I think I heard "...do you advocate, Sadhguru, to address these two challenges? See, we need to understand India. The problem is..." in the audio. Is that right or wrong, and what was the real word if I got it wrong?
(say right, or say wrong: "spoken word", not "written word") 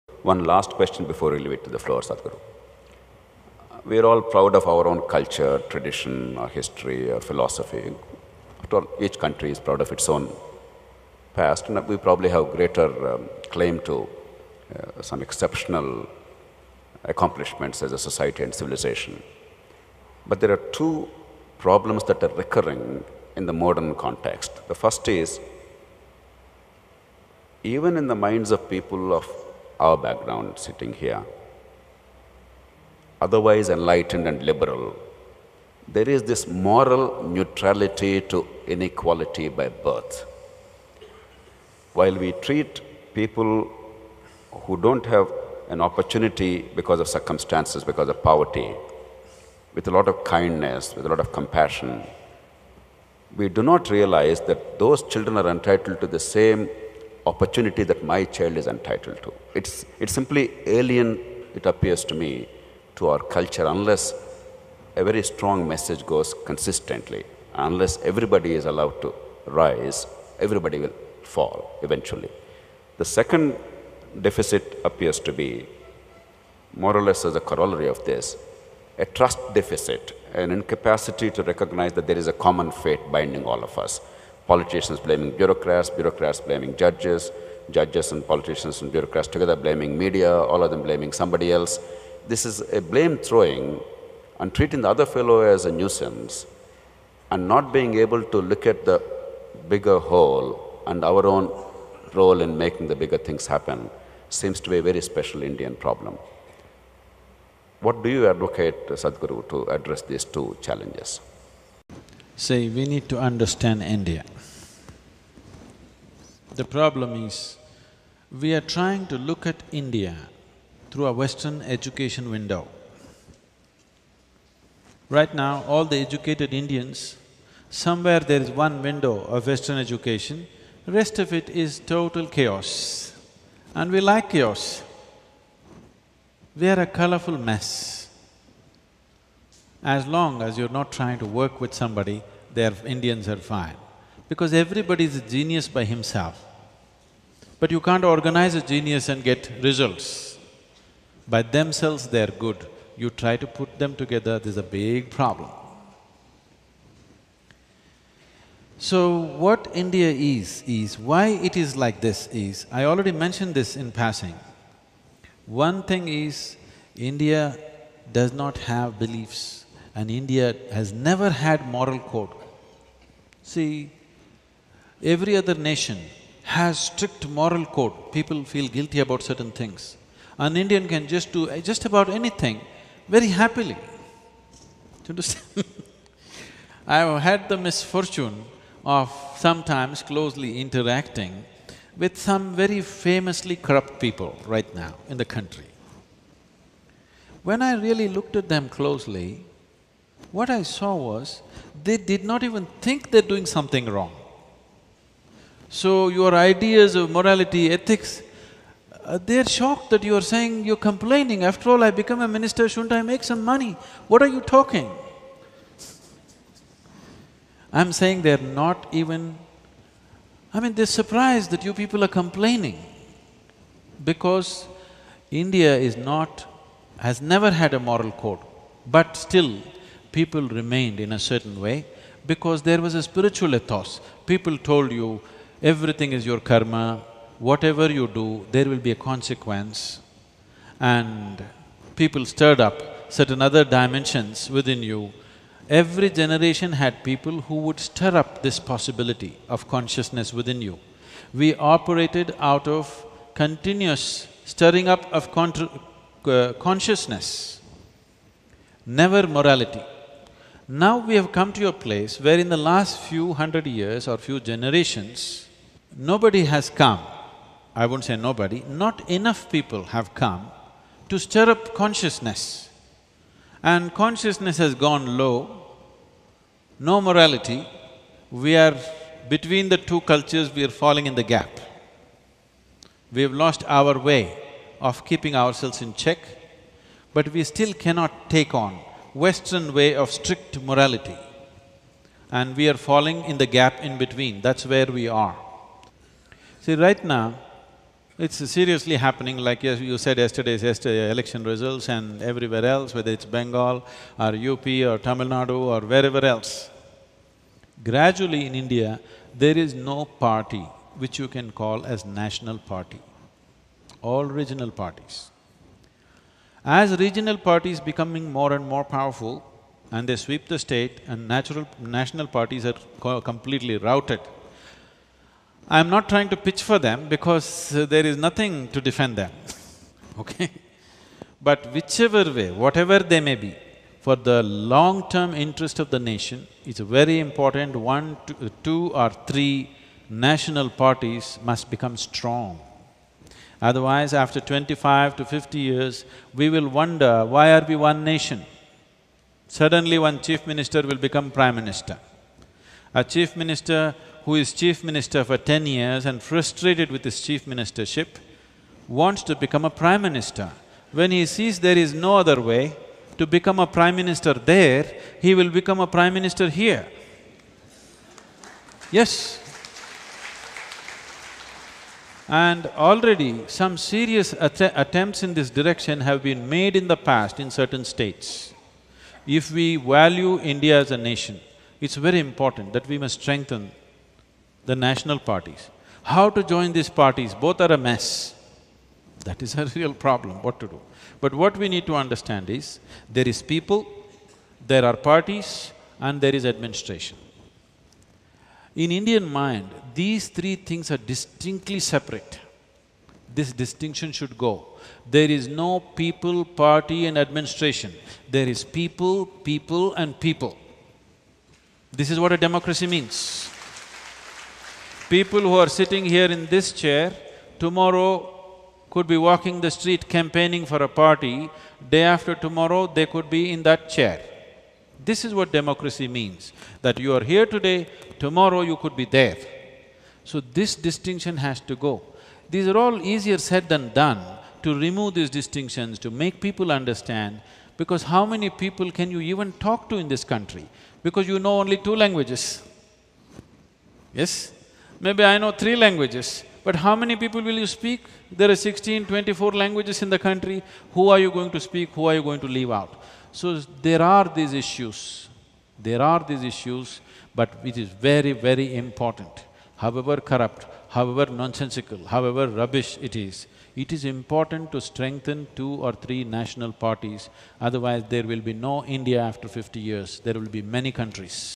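right.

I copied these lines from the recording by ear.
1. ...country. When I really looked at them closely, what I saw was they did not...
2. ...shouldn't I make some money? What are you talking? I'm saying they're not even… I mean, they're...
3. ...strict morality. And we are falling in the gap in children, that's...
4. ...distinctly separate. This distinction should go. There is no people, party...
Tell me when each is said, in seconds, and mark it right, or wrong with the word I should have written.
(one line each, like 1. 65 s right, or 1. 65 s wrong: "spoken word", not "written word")
1. 195 s right
2. 212 s right
3. 290 s wrong: "between", not "children"
4. 400 s right.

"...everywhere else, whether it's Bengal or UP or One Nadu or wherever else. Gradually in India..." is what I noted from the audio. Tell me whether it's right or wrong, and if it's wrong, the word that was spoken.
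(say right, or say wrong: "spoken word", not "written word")
wrong: "Tamil", not "One".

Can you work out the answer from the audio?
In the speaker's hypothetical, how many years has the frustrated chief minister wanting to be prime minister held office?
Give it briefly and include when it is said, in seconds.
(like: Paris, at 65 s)
10 years, at 355 s.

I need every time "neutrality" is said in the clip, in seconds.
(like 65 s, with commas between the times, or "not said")
37 s.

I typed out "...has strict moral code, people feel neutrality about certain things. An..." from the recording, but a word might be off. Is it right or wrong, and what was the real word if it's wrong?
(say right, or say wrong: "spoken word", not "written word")
wrong: "guilty", not "neutrality".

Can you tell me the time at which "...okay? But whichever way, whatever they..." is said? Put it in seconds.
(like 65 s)
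330 s.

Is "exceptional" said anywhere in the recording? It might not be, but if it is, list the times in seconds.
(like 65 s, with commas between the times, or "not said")
15 s.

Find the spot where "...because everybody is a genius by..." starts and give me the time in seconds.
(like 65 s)
144 s.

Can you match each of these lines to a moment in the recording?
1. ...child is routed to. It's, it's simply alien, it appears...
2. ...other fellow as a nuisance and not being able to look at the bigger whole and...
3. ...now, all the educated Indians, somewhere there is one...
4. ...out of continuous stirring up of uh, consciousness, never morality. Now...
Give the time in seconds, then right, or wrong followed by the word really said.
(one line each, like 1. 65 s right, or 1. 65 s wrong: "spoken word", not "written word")
1. 58 s wrong: "entitled", not "routed"
2. 94 s right
3. 125 s right
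4. 252 s right.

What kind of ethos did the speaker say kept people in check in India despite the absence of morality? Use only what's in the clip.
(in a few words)
spiritual ethos.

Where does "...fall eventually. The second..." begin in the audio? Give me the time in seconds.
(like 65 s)
71 s.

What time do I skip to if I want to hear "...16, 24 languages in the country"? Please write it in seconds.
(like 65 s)
448 s.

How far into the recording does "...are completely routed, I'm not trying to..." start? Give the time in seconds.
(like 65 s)
322 s.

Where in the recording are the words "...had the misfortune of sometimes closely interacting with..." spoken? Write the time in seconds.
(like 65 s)
187 s.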